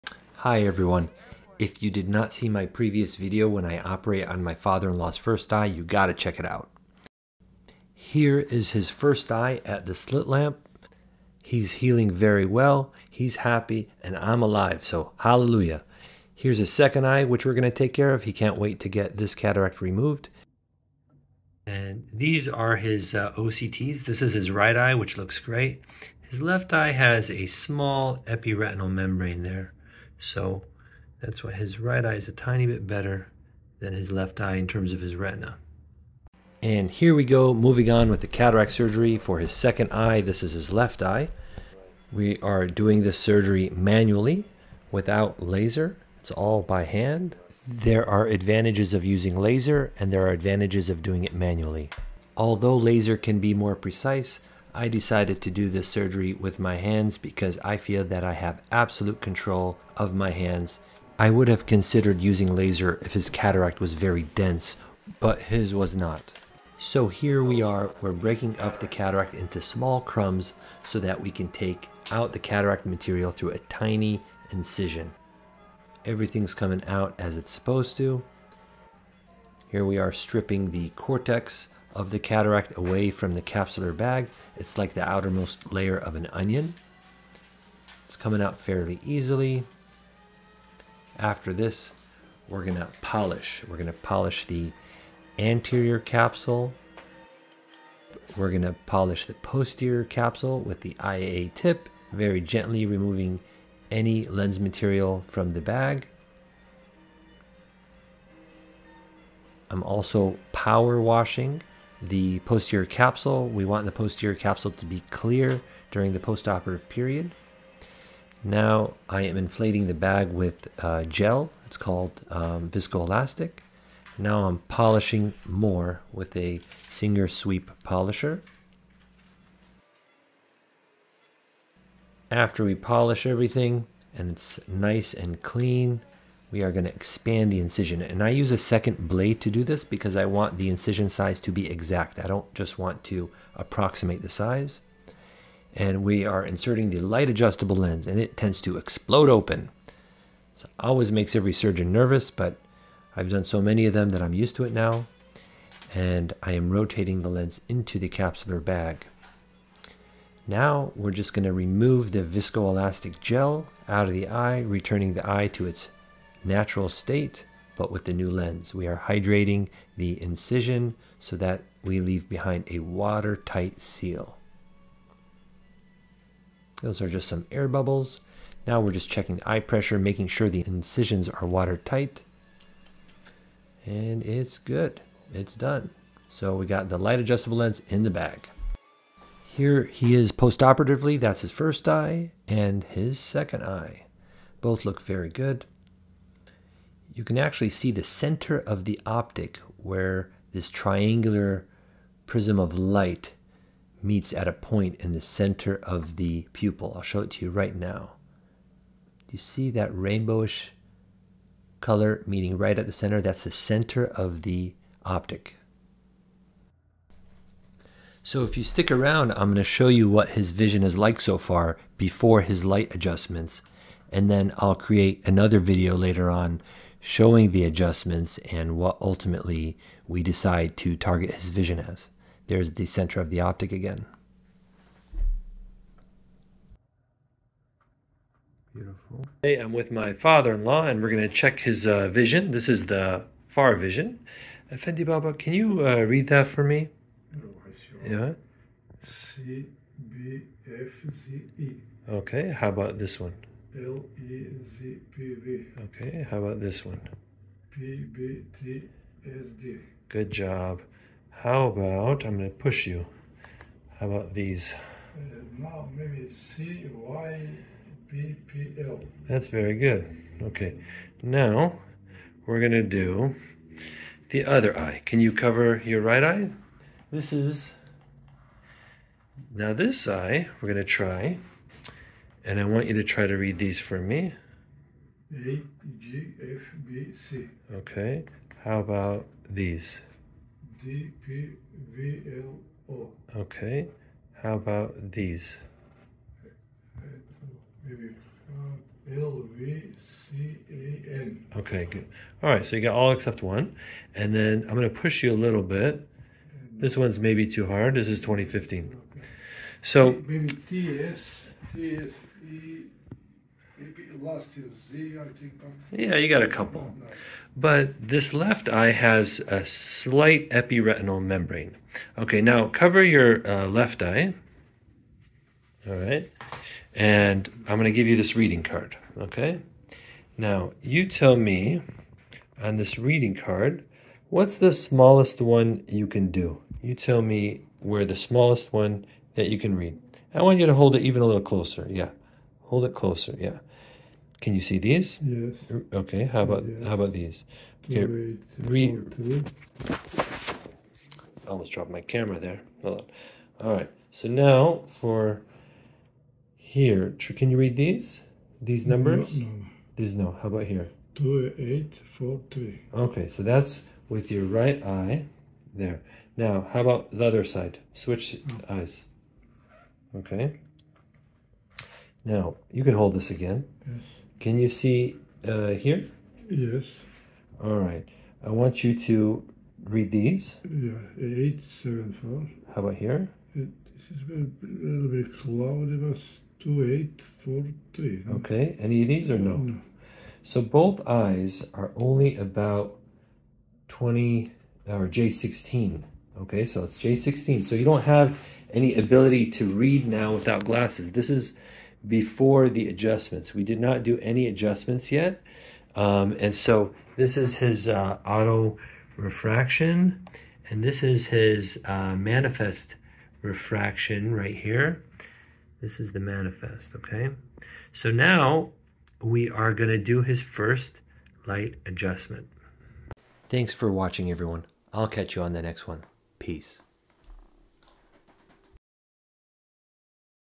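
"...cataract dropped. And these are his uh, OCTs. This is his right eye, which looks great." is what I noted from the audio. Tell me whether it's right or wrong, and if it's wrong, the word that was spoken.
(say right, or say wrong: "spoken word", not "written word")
wrong: "removed", not "dropped".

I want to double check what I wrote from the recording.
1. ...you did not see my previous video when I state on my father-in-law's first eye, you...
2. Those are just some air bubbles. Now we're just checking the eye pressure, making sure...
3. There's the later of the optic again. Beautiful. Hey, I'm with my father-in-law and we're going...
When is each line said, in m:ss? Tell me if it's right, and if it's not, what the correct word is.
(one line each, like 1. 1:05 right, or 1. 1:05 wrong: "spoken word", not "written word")
1. 0:01 wrong: "operate", not "state"
2. 2:56 right
3. 3:52 wrong: "center", not "later".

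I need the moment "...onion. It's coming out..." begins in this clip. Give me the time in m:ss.
1:26.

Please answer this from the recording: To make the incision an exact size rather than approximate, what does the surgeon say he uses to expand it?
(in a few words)
A second blade.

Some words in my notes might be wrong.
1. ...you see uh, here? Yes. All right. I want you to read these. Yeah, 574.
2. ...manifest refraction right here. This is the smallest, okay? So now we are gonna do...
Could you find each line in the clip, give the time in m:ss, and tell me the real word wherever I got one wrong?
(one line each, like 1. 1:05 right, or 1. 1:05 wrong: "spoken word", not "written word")
1. 6:14 wrong: "874", not "574"
2. 6:52 wrong: "manifest", not "smallest".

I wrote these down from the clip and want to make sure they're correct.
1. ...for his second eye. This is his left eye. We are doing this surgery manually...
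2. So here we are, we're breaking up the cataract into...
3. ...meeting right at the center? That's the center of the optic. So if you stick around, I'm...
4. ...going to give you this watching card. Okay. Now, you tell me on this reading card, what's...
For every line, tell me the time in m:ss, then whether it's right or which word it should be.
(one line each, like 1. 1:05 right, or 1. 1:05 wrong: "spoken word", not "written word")
1. 0:39 right
2. 1:06 right
3. 3:32 right
4. 5:27 wrong: "reading", not "watching".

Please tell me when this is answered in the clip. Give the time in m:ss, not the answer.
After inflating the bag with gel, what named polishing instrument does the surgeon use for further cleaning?
2:06.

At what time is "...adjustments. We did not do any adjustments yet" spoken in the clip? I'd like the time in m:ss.
6:42.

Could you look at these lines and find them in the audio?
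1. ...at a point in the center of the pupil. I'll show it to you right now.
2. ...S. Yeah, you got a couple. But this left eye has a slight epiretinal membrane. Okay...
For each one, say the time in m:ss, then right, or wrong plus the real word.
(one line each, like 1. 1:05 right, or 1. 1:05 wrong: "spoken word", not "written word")
1. 3:24 right
2. 5:11 right.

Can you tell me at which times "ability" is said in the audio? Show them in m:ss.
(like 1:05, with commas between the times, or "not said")
6:38.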